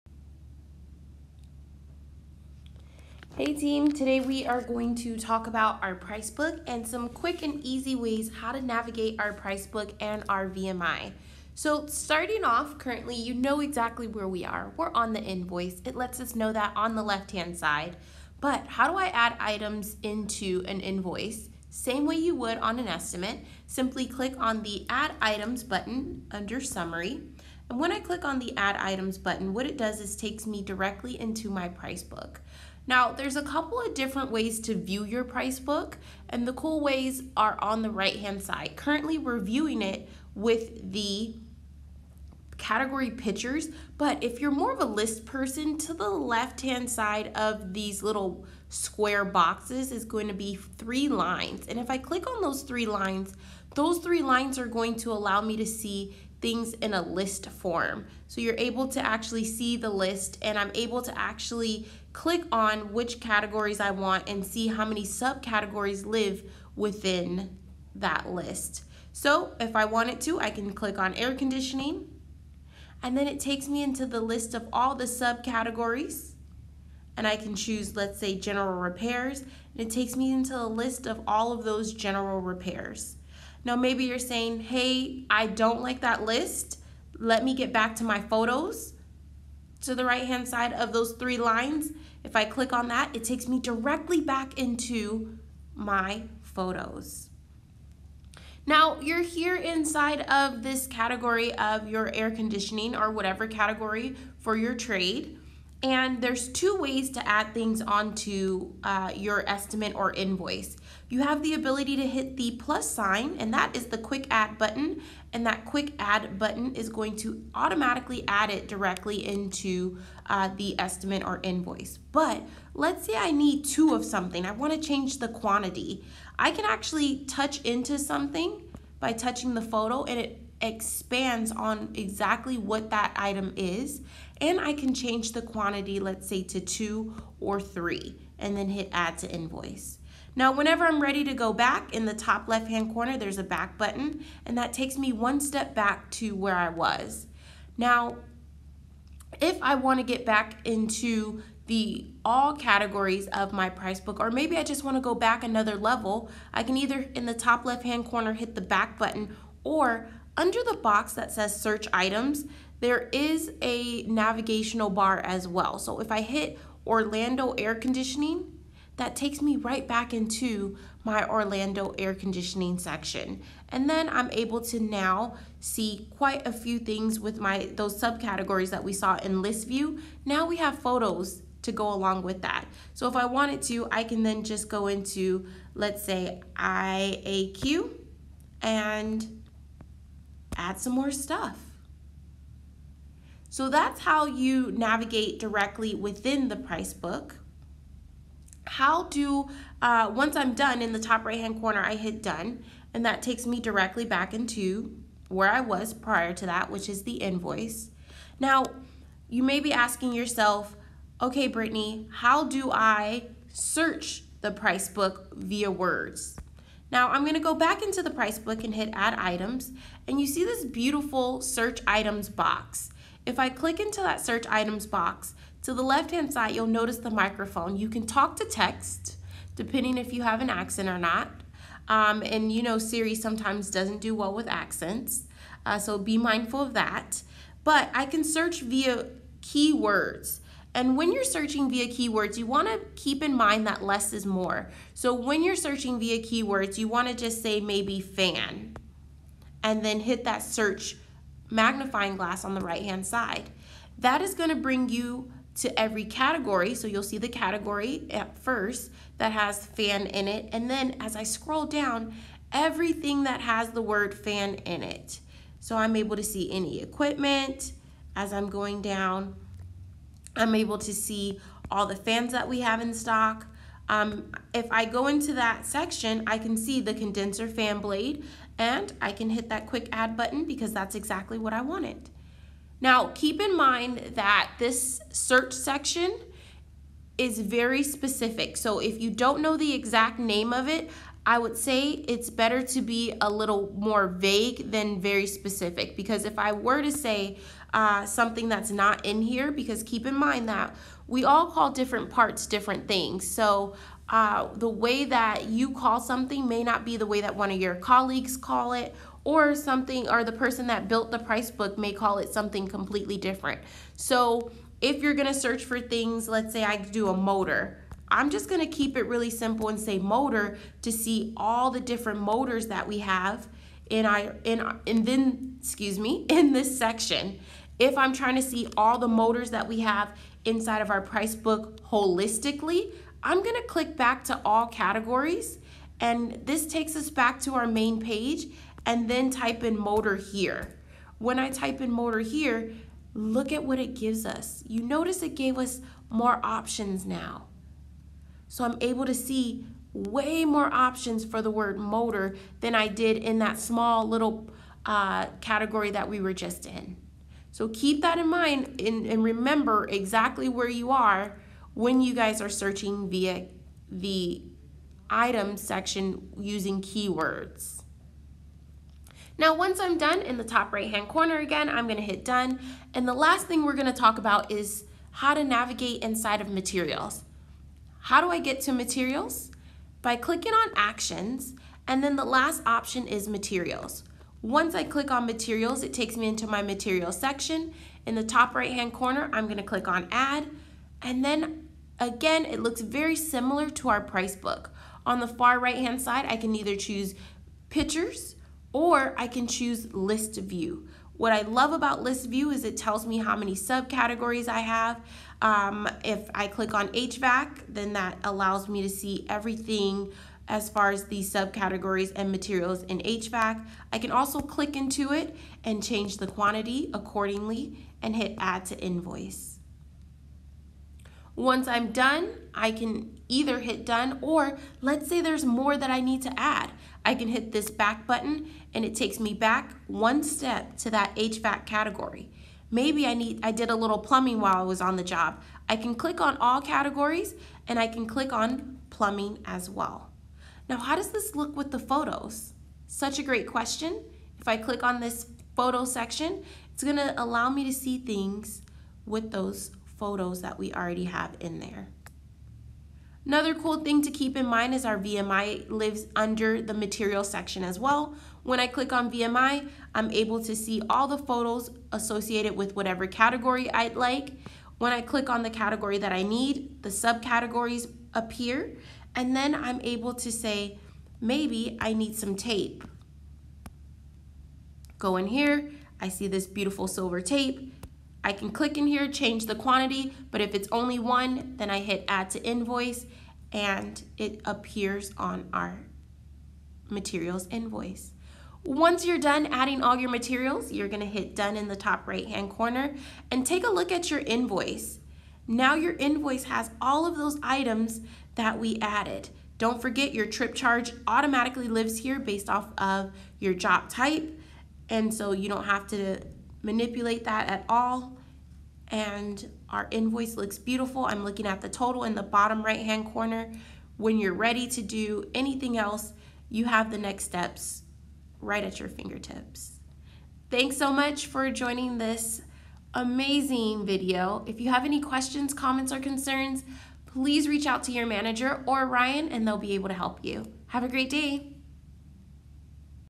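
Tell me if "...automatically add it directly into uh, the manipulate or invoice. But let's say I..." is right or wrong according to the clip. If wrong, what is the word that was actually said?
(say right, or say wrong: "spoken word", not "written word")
wrong: "estimate", not "manipulate".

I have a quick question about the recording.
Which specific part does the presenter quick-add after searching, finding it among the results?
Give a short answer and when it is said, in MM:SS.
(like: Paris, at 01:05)
Condenser fan blade, at 04:36.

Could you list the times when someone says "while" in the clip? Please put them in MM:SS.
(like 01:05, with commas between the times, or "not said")
07:14.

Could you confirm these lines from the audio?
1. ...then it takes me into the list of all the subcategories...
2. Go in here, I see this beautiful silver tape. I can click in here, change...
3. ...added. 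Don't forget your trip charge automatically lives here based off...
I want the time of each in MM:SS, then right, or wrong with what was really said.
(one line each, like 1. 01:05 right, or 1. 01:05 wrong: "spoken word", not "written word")
1. 01:13 right
2. 07:54 right
3. 08:18 right.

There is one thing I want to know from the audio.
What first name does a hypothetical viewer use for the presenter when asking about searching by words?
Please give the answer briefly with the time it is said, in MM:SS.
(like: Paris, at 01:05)
Brittani, at 03:31.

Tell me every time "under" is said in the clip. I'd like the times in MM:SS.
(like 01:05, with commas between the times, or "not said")
00:26, 02:40, 07:36.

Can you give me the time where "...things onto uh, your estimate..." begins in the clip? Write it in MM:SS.
01:47.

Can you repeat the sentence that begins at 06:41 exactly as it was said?
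What I love about list view is it tells me how many subcategories I have.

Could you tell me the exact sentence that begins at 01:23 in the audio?
Now, maybe you're saying, hey, I don't like that list.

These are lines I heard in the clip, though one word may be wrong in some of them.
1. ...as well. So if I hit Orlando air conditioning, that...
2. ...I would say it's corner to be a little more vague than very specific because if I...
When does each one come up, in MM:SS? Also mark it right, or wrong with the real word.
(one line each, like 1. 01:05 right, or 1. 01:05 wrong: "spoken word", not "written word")
1. 02:45 right
2. 04:51 wrong: "better", not "corner".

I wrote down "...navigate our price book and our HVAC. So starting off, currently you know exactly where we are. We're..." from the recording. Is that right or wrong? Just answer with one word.
wrong.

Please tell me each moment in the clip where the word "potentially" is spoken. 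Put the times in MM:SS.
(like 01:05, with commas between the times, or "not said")
not said.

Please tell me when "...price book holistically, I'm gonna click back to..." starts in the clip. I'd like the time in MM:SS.
05:31.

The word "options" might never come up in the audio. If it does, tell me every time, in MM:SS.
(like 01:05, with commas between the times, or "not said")
05:46, 05:50, 06:22.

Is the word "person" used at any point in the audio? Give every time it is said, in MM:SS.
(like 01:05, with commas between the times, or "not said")
00:45, 05:10.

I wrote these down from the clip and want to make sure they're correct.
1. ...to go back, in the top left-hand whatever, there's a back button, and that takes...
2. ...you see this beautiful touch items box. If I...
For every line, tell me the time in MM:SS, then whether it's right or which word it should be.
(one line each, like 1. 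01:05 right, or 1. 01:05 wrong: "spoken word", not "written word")
1. 02:21 wrong: "corner", not "whatever"
2. 03:40 wrong: "search", not "touch".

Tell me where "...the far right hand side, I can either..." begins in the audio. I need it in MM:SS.
06:35.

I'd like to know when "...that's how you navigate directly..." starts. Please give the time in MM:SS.
03:13.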